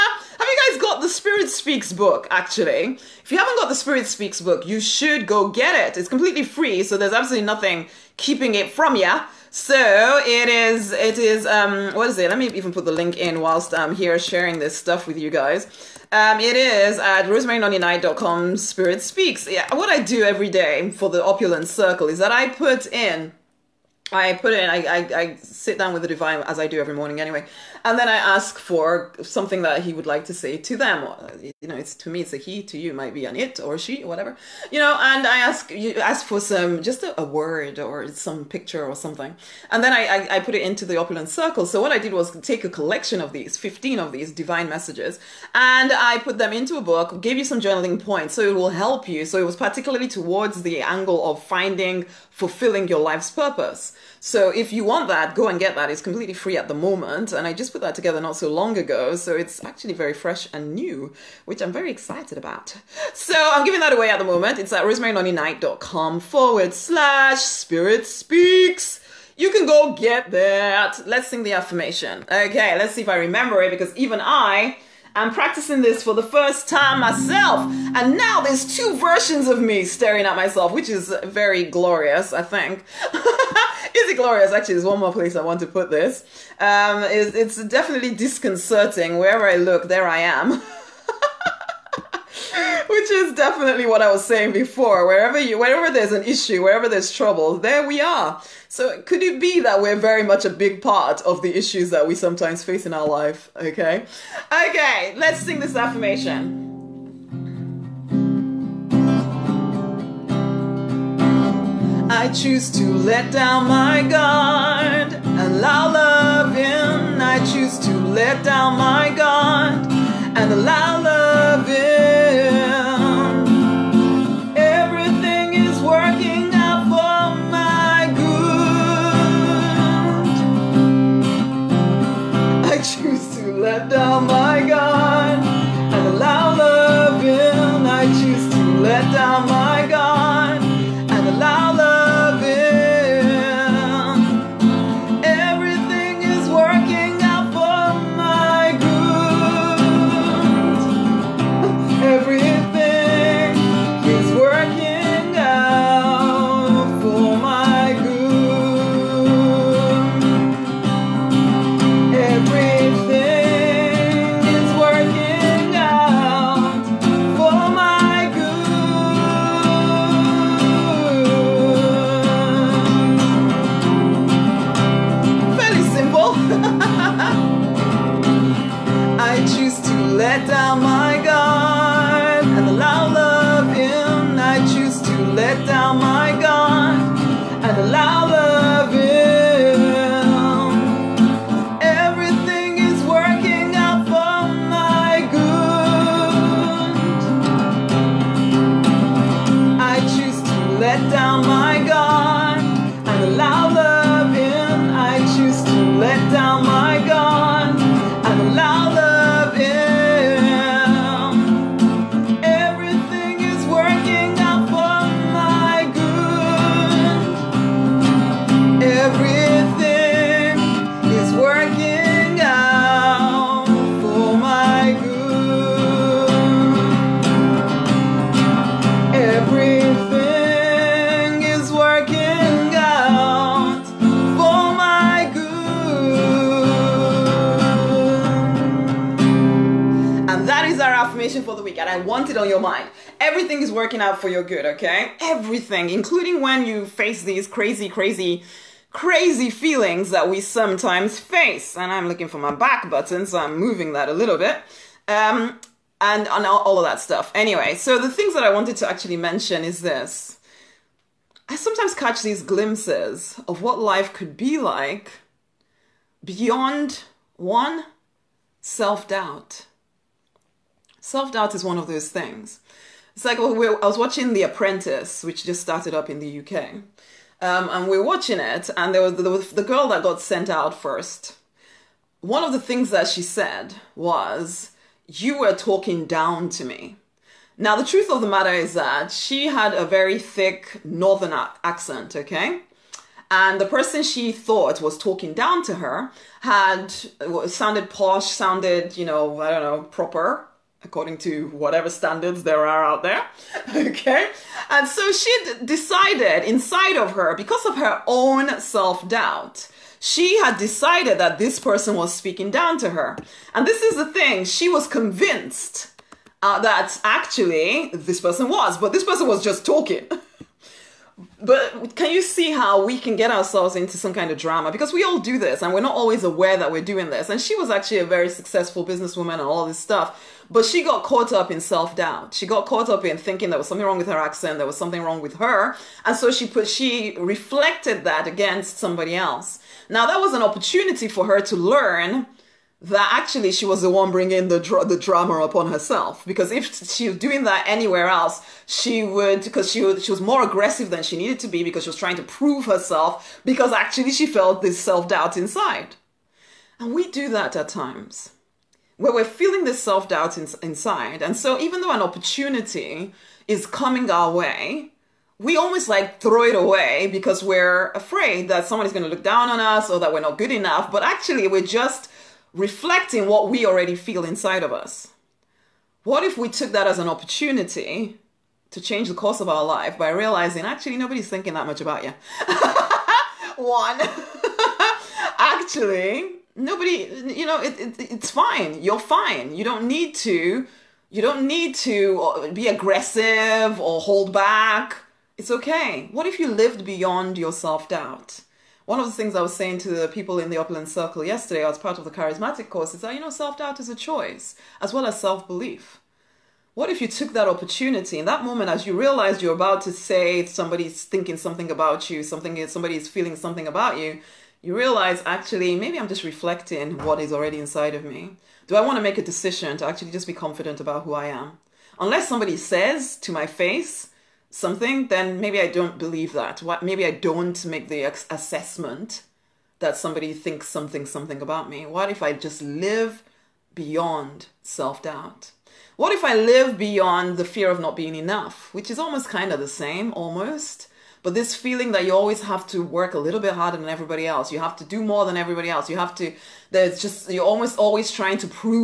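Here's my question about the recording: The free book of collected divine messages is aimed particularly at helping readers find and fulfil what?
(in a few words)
Life's purpose.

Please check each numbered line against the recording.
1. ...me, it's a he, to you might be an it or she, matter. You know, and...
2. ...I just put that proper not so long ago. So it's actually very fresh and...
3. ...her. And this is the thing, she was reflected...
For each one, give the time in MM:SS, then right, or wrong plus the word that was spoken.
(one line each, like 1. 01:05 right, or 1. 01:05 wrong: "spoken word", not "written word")
1. 00:32 wrong: "whatever", not "matter"
2. 00:57 wrong: "together", not "proper"
3. 05:12 wrong: "convinced", not "reflected".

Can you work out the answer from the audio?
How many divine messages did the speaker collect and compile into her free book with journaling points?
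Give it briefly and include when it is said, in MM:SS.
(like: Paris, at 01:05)
15, at 00:43.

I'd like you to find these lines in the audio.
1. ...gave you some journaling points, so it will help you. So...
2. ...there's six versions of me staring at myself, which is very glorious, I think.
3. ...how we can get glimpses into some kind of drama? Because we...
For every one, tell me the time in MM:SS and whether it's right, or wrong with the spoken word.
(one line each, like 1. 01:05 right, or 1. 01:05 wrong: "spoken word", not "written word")
1. 00:47 right
2. 01:18 wrong: "two", not "six"
3. 05:22 wrong: "ourselves", not "glimpses".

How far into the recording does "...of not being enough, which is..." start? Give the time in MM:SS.
07:17.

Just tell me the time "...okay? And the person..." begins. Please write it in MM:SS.
04:52.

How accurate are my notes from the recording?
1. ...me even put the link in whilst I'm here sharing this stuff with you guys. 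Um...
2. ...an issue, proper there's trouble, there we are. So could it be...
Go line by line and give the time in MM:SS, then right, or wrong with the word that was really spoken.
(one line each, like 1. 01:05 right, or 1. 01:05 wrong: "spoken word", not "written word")
1. 00:12 right
2. 01:36 wrong: "wherever", not "proper".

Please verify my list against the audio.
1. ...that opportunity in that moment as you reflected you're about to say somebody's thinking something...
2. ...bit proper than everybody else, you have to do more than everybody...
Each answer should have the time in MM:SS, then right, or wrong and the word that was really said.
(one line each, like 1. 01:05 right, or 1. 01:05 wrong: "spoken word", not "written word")
1. 06:47 wrong: "realized", not "reflected"
2. 07:23 wrong: "harder", not "proper".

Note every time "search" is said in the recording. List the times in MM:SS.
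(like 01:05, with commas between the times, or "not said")
not said.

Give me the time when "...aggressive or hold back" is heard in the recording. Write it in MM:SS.
06:32.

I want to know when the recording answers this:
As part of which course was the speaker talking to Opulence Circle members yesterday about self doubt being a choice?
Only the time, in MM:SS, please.
06:42.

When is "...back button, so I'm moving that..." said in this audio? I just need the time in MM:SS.
04:12.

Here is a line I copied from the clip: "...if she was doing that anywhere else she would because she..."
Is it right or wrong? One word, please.
right.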